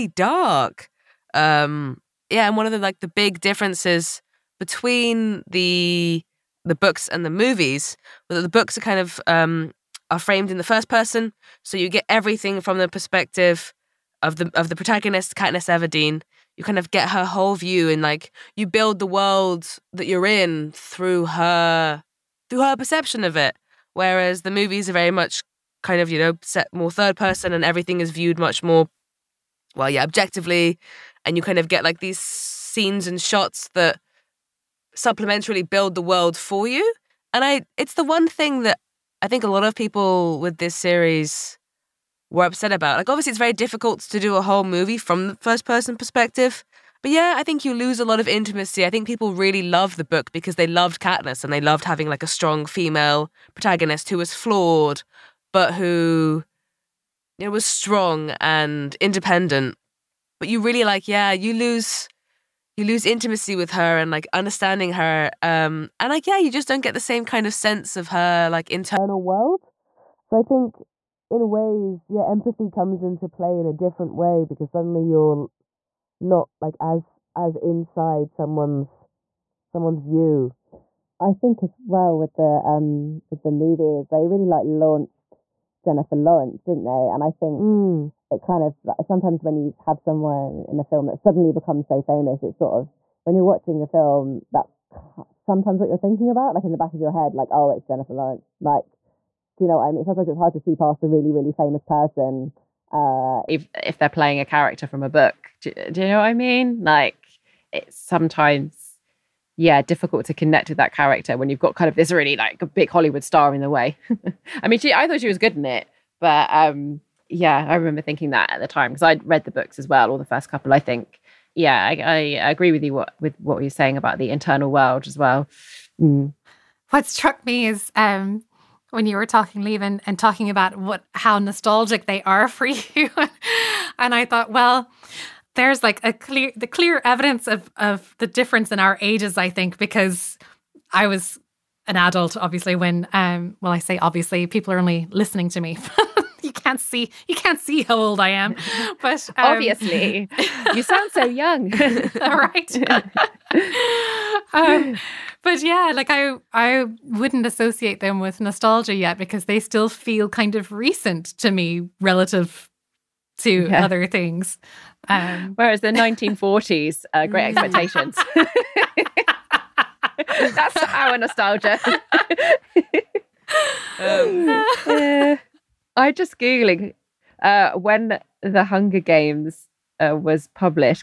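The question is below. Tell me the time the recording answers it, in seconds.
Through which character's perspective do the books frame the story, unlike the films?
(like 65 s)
15 s.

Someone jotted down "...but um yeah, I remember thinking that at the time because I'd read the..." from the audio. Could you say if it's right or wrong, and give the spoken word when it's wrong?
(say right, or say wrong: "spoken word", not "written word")
right.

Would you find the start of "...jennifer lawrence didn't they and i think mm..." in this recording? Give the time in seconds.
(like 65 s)
85 s.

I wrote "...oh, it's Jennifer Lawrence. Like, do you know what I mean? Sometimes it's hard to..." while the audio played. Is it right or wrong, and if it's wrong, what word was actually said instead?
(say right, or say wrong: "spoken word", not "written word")
right.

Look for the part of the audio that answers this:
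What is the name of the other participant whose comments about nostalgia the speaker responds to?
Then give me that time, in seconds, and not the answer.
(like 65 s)
129 s.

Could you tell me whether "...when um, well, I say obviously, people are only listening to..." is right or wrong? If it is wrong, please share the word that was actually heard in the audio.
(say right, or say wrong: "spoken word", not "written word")
right.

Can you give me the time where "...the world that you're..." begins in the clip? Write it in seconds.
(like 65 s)
18 s.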